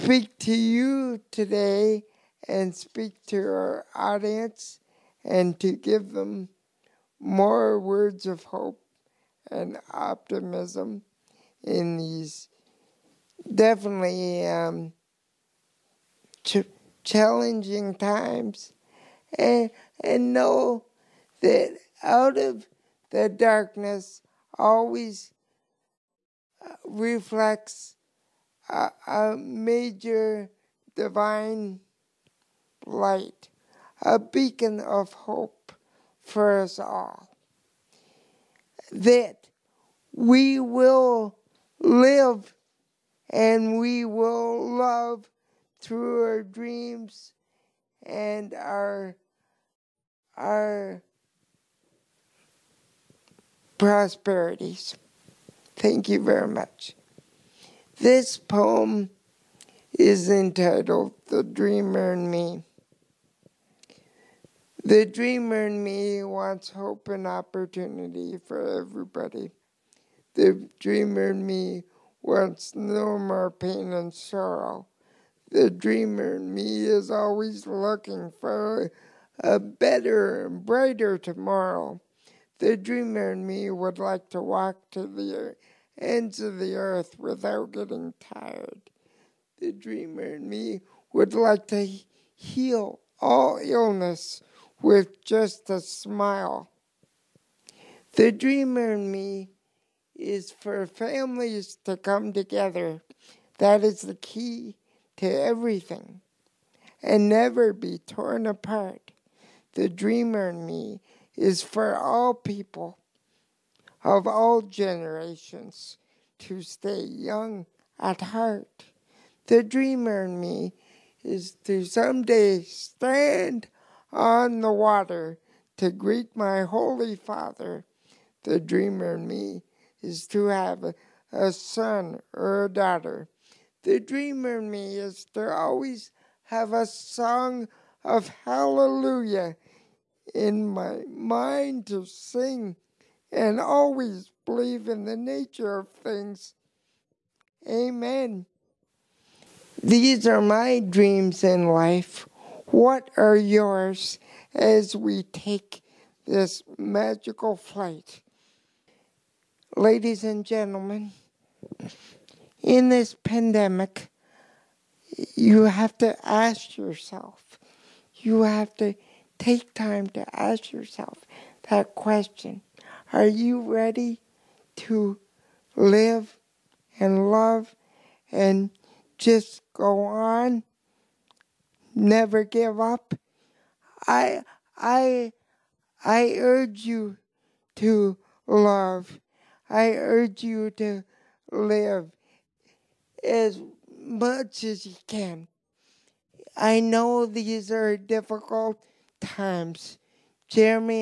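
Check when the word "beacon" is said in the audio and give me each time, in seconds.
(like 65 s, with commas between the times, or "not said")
34 s.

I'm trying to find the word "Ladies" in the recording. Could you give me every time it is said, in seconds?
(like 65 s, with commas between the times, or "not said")
159 s.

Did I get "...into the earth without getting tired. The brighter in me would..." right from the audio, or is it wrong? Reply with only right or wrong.
wrong.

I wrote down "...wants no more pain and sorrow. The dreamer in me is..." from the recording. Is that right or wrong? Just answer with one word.
right.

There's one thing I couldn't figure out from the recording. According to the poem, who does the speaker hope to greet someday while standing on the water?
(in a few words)
Holy Father.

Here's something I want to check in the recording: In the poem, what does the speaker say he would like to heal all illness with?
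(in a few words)
A smile.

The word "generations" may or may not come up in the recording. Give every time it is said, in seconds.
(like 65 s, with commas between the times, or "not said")
114 s.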